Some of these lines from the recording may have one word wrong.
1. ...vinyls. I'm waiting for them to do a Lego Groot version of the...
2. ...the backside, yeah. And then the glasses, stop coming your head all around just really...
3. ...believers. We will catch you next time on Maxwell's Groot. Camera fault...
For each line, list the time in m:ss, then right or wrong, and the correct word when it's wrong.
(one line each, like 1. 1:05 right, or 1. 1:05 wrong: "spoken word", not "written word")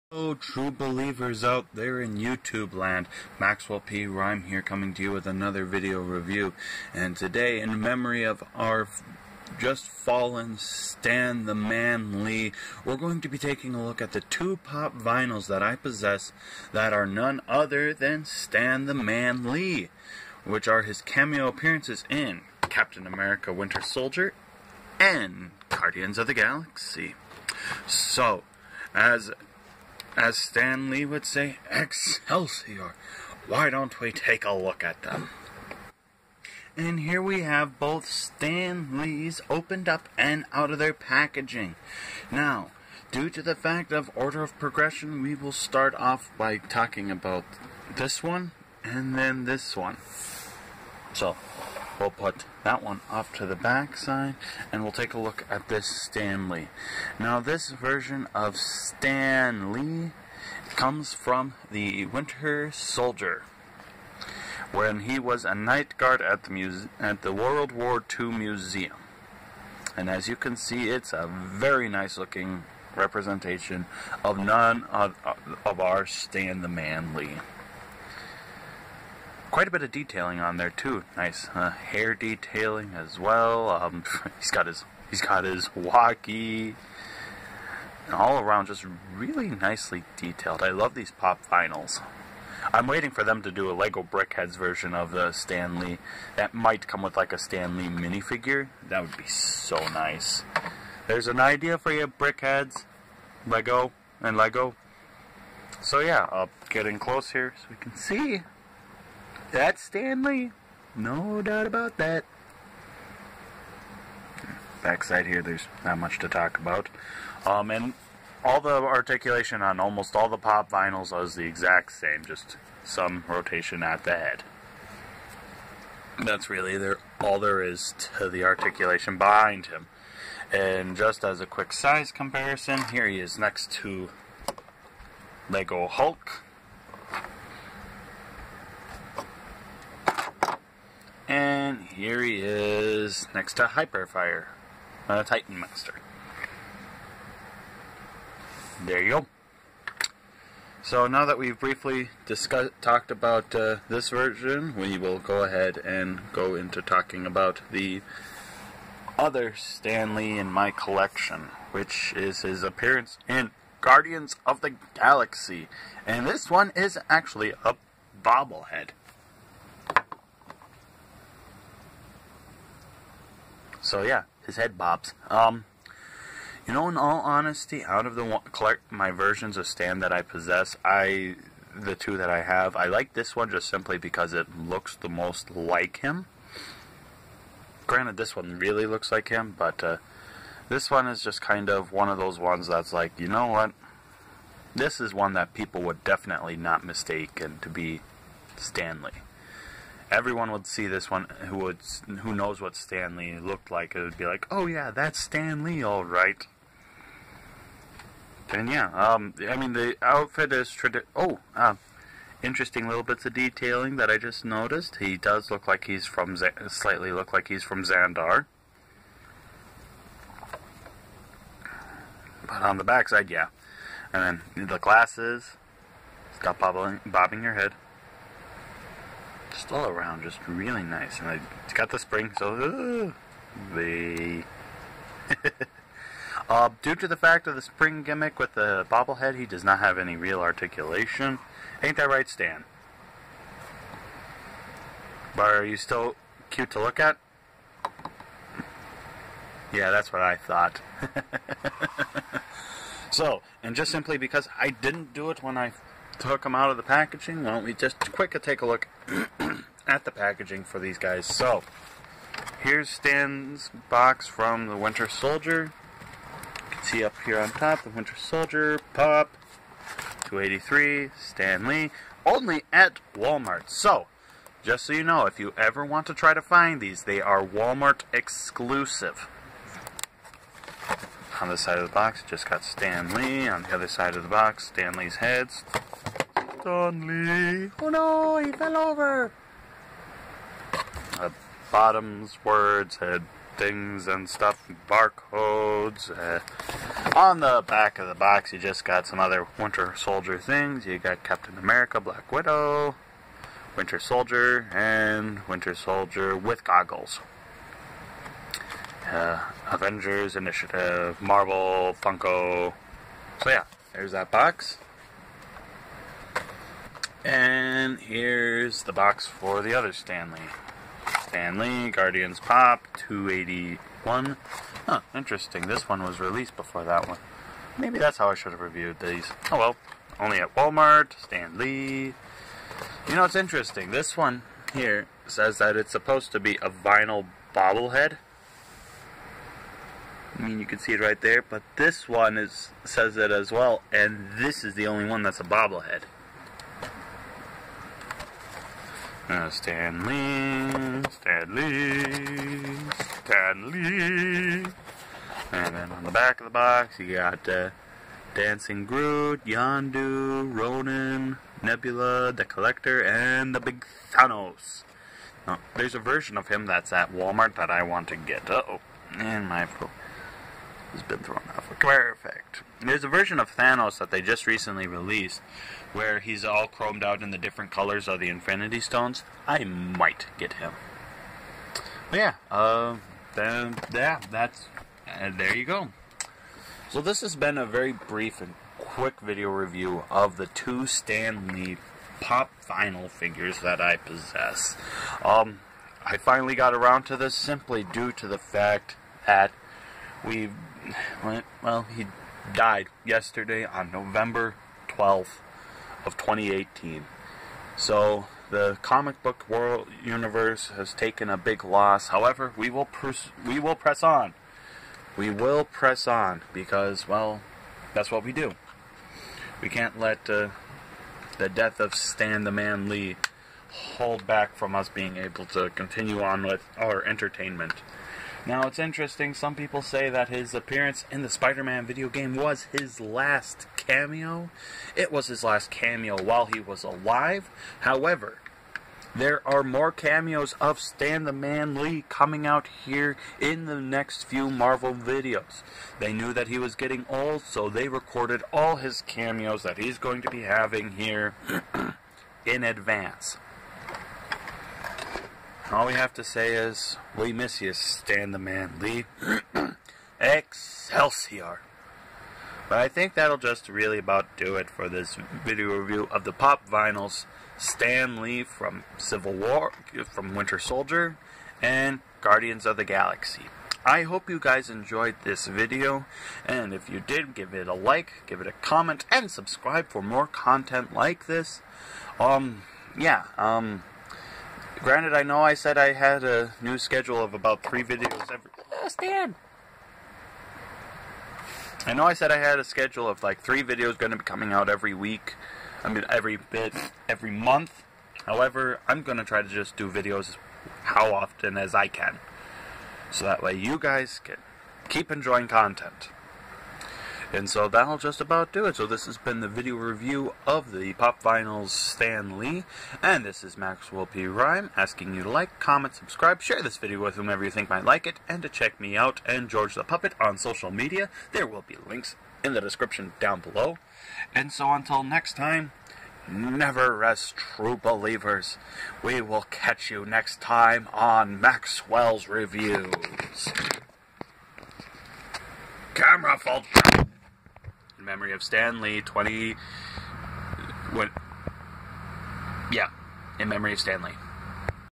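1. 1:31 wrong: "BrickHeadz", not "Groot"
2. 3:42 wrong: "bobbing", not "coming"
3. 8:47 wrong: "Reviews", not "Groot".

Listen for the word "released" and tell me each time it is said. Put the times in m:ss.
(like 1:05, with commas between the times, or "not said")
5:26, 6:14.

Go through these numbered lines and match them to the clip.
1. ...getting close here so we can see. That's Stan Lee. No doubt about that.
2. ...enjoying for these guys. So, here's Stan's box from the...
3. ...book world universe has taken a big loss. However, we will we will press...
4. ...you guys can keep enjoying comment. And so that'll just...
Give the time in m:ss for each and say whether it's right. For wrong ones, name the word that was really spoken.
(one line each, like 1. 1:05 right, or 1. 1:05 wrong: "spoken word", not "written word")
1. 1:46 right
2. 4:20 wrong: "packaging", not "enjoying"
3. 6:49 right
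4. 8:23 wrong: "content", not "comment".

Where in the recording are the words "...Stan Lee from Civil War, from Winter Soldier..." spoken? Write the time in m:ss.
7:47.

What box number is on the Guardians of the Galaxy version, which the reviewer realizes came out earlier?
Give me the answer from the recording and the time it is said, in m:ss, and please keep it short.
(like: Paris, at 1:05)
281, at 5:23.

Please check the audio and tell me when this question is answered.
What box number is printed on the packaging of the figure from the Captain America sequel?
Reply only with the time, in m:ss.
4:30.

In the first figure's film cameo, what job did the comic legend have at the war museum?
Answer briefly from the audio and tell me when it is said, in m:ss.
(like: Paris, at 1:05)
Night guard, at 1:05.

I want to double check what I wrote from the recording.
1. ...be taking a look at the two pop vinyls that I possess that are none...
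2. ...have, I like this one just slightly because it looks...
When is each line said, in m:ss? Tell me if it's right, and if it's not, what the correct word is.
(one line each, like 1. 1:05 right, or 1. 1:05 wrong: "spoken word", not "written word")
1. 0:13 right
2. 3:02 wrong: "simply", not "slightly".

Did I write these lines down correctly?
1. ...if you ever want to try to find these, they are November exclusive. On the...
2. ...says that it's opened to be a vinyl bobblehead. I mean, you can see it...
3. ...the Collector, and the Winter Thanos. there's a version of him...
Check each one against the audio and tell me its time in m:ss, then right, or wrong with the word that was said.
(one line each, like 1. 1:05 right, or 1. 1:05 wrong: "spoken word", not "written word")
1. 4:35 wrong: "Walmart", not "November"
2. 5:35 wrong: "supposed", not "opened"
3. 6:02 wrong: "Big", not "Winter".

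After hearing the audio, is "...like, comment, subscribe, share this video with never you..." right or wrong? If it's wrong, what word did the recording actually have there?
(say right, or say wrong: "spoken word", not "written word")
wrong: "whomever", not "never".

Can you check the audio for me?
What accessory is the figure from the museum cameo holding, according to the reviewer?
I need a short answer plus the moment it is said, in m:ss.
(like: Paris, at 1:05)
Walkie, at 1:25.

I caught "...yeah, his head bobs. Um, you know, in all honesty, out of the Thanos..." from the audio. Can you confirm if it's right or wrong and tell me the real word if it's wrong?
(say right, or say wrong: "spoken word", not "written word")
wrong: "Clark", not "Thanos".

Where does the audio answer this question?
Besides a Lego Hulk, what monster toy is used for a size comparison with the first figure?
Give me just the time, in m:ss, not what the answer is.
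2:23.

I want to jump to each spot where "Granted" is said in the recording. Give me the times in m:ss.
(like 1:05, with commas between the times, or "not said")
3:07, 8:04.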